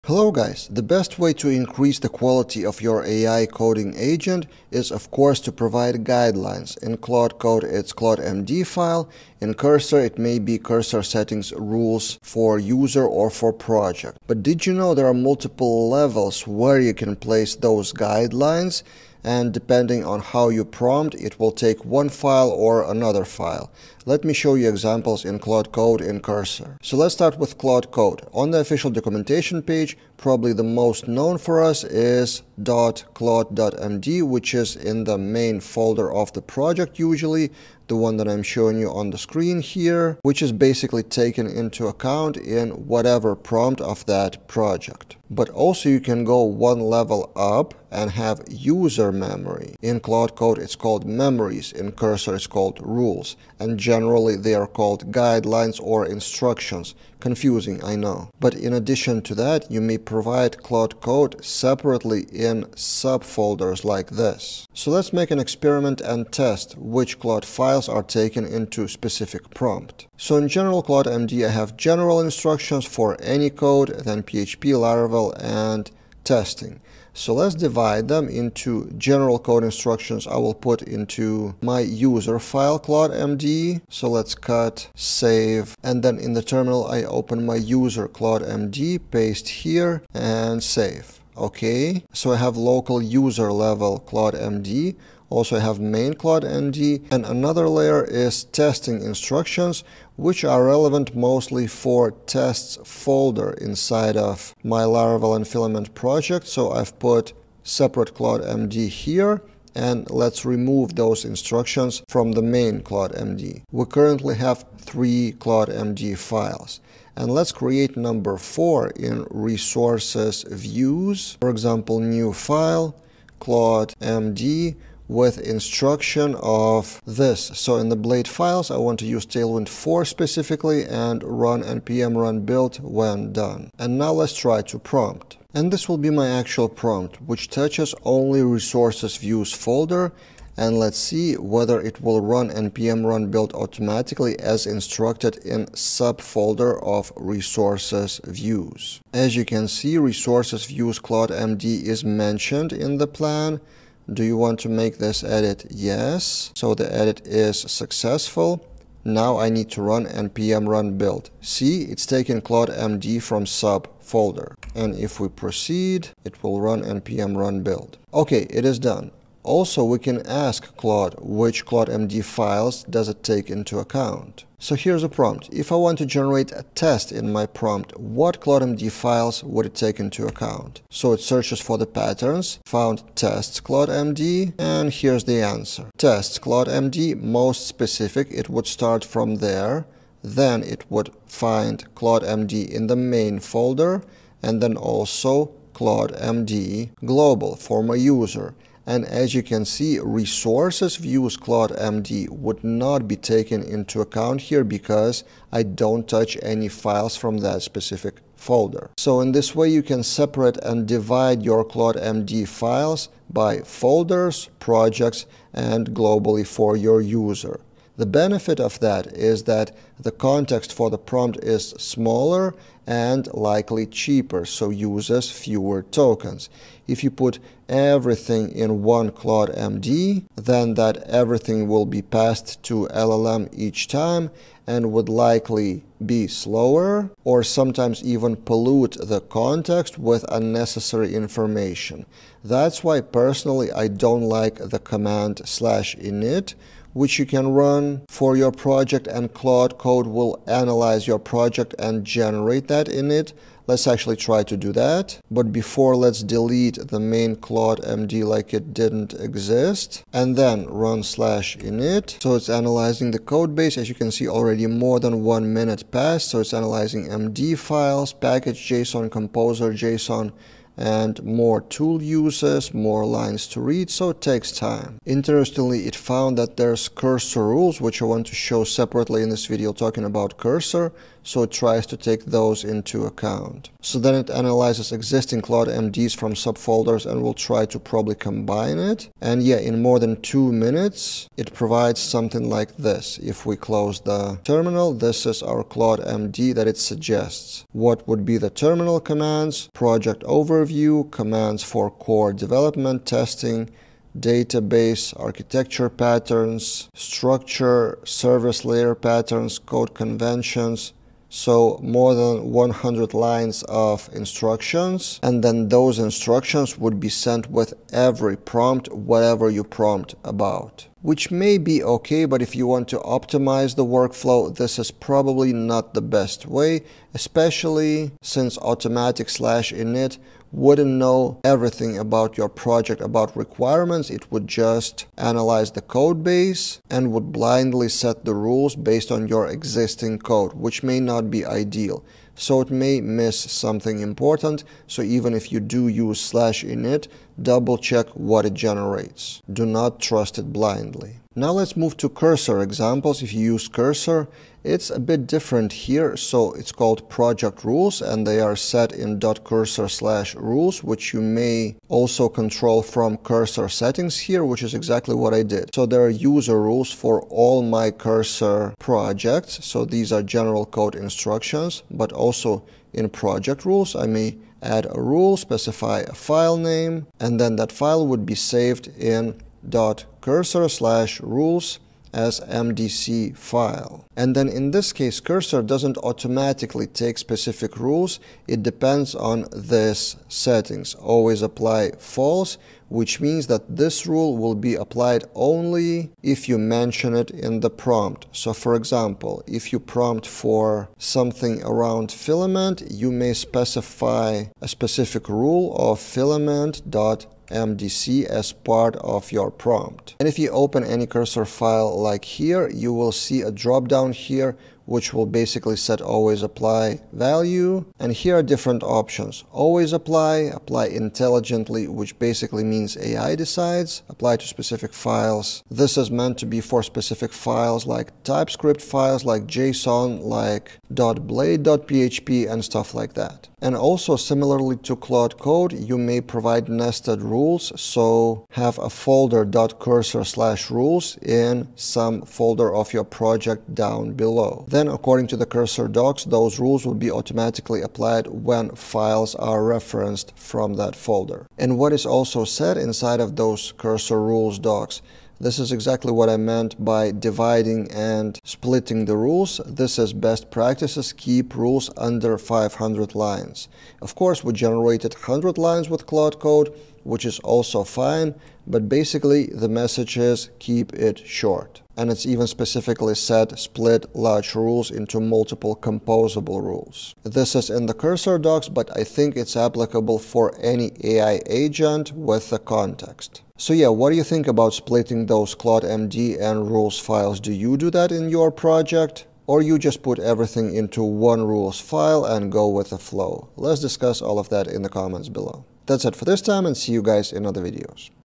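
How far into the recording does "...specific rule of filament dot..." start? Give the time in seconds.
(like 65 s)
404 s.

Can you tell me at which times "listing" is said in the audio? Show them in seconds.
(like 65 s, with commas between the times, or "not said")
not said.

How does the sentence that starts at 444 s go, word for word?
Then according to the cursor docs, those rules will be automatically applied when files are referenced from that folder.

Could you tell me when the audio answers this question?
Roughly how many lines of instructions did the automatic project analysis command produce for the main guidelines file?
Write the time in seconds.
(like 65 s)
311 s.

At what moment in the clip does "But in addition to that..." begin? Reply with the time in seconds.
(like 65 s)
58 s.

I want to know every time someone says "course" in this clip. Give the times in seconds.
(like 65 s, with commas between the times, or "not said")
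5 s, 464 s.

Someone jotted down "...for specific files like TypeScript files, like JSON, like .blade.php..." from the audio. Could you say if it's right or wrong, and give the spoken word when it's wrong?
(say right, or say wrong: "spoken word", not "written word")
right.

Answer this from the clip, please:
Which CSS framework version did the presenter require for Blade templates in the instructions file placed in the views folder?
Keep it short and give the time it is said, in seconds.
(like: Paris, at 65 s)
Tailwind 4, at 129 s.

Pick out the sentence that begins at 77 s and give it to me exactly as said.
So let's divide them into general code instructions I will put into my user file md.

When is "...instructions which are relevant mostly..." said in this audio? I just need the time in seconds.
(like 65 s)
99 s.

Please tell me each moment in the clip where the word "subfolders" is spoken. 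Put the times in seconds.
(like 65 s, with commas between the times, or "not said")
62 s, 145 s, 286 s.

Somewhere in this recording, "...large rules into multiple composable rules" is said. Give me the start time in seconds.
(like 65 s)
474 s.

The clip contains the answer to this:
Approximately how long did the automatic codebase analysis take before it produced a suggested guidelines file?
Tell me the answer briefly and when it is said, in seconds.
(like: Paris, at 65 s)
more than two minutes, at 289 s.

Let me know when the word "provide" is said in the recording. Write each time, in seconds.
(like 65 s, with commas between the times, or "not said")
5 s, 59 s, 291 s, 436 s.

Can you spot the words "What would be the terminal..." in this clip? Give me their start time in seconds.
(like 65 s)
297 s.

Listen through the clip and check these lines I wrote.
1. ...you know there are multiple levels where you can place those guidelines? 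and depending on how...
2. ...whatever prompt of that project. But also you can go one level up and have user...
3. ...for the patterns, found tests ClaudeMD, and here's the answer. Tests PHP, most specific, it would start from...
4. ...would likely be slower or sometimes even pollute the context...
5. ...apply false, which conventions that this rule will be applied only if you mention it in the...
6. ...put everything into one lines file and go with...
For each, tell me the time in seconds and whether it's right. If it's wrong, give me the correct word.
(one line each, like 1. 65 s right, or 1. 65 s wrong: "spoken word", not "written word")
1. 14 s right
2. 42 s right
3. 181 s wrong: "ClaudeMD", not "PHP"
4. 234 s right
5. 391 s wrong: "means", not "conventions"
6. 490 s wrong: "rules", not "lines".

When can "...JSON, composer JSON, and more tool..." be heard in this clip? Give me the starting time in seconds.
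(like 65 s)
268 s.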